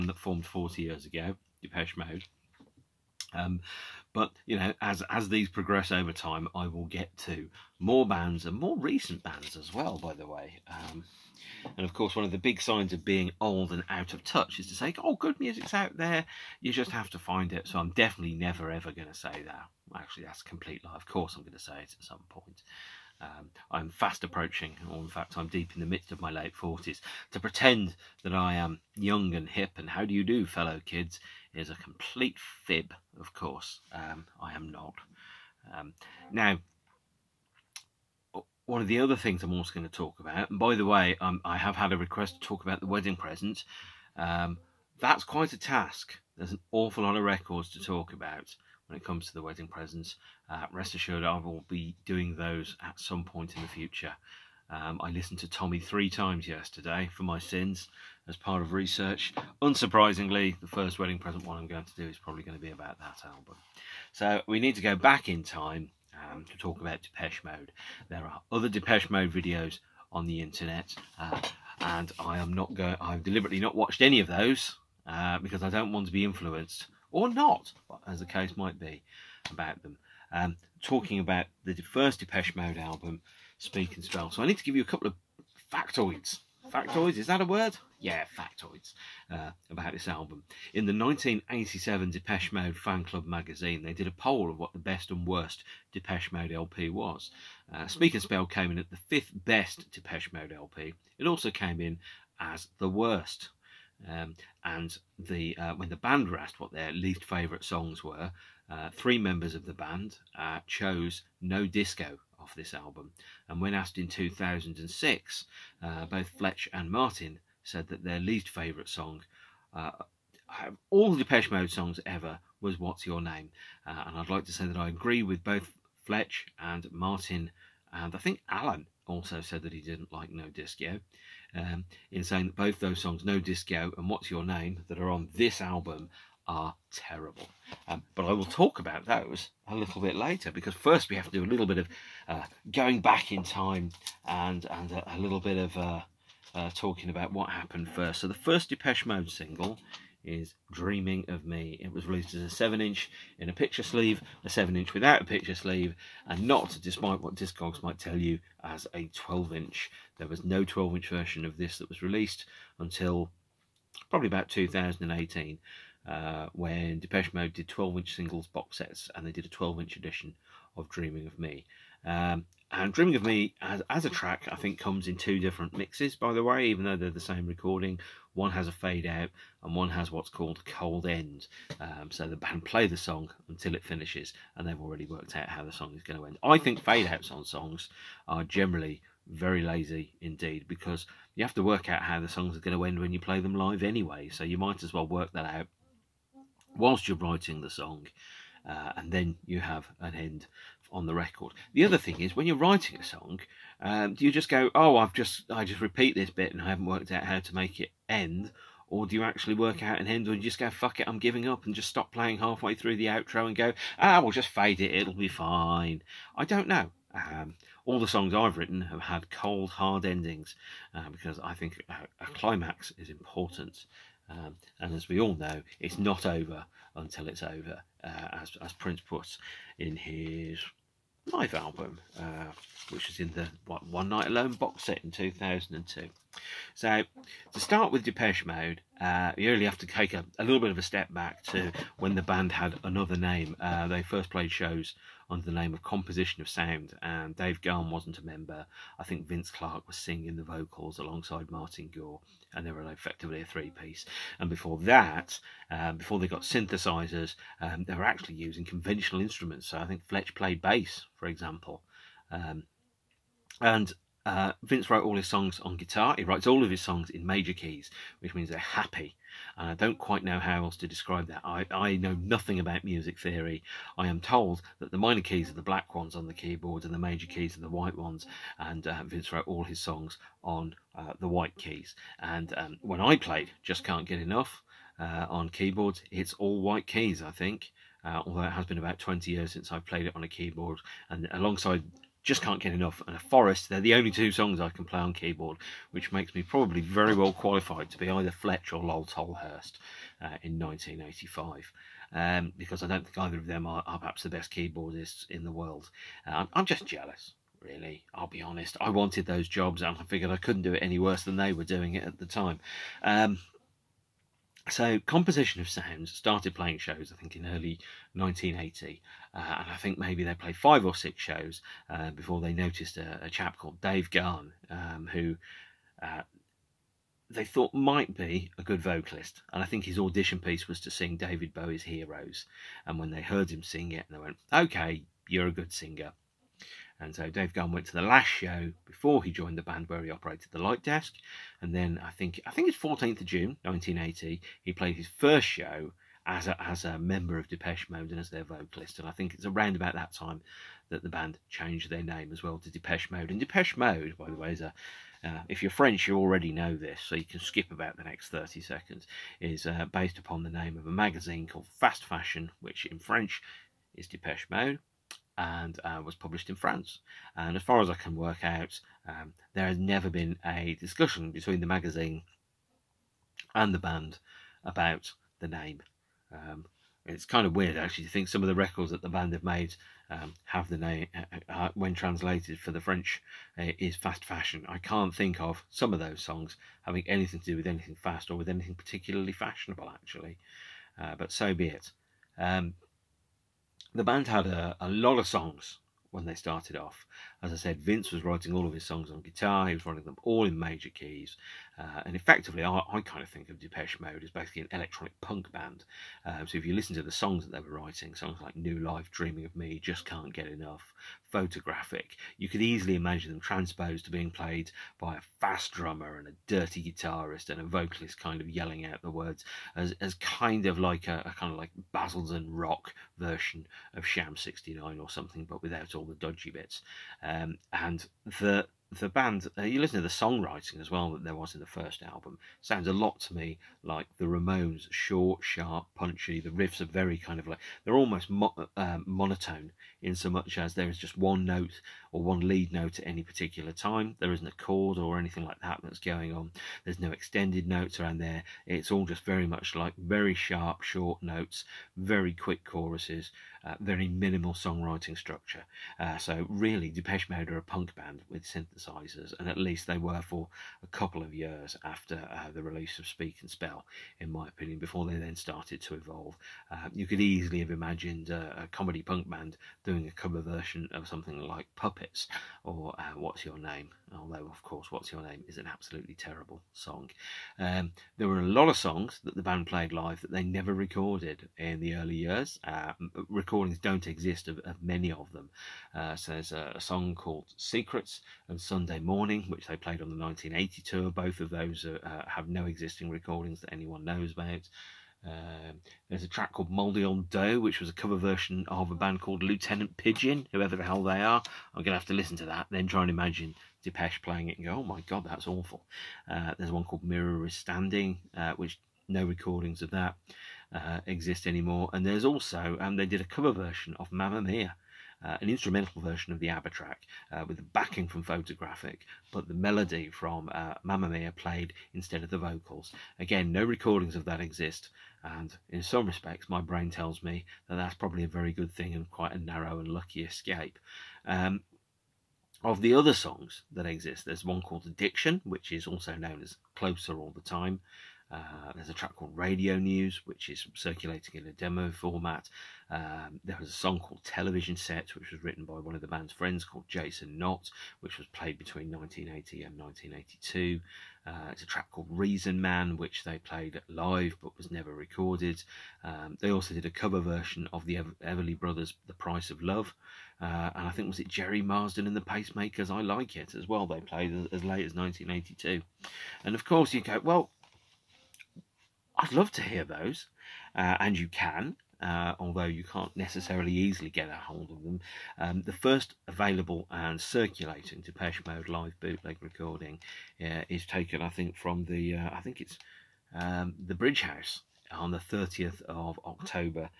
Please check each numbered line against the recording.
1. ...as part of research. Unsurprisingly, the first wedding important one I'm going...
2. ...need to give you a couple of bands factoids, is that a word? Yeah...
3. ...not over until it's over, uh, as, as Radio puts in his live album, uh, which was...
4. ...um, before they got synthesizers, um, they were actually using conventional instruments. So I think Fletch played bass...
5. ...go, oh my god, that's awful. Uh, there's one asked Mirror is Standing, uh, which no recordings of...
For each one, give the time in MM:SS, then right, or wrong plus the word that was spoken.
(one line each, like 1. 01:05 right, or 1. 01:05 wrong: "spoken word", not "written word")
1. 00:58 wrong: "present", not "important"
2. 01:24 wrong: "factoids", not "bands"
3. 03:45 wrong: "Prince", not "Radio"
4. 04:15 right
5. 08:24 wrong: "called", not "asked".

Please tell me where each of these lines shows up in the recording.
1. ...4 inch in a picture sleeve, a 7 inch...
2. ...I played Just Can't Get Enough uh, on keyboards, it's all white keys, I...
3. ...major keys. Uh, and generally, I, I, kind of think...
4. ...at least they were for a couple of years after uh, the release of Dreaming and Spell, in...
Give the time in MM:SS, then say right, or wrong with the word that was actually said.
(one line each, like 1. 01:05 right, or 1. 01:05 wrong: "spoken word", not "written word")
1. 02:32 wrong: "7", not "4"
2. 04:43 right
3. 06:40 wrong: "effectively", not "generally"
4. 07:39 wrong: "Speak", not "Dreaming".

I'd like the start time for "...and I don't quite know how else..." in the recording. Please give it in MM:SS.
04:29.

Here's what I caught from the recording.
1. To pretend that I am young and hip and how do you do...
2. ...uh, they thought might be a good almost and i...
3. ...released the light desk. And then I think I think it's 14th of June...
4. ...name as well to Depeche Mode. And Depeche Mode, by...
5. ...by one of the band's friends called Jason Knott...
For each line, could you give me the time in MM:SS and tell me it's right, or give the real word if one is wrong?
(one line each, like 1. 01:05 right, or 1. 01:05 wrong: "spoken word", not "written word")
1. 00:27 right
2. 05:26 wrong: "vocalist", not "almost"
3. 05:40 wrong: "operated", not "released"
4. 05:52 right
5. 09:05 right.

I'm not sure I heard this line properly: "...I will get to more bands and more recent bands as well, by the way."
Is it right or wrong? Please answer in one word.
right.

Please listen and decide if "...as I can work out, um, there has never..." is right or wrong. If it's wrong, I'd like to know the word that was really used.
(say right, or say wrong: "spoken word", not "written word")
right.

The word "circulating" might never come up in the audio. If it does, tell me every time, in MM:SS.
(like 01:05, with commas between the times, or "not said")
09:00, 09:37.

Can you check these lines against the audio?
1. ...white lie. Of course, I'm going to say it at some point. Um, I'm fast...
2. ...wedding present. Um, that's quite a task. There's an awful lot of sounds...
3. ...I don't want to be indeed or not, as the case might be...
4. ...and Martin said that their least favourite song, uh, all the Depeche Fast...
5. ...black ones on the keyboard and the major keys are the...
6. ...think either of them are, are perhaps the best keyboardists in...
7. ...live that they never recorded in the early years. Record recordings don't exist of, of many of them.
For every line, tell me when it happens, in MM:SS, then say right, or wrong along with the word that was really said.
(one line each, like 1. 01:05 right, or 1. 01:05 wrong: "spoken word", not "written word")
1. 00:20 wrong: "complete", not "white"
2. 00:42 wrong: "records", not "sounds"
3. 01:15 wrong: "influenced", not "indeed"
4. 01:56 wrong: "Mode", not "Fast"
5. 04:35 right
6. 05:03 right
7. 07:59 right.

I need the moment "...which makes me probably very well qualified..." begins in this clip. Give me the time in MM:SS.
04:55.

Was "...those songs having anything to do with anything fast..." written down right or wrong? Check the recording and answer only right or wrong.
right.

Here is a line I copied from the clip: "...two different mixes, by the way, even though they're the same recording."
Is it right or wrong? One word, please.
right.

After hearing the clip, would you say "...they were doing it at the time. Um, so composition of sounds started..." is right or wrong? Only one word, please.
right.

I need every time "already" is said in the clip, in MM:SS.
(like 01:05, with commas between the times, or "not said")
03:04, 05:56.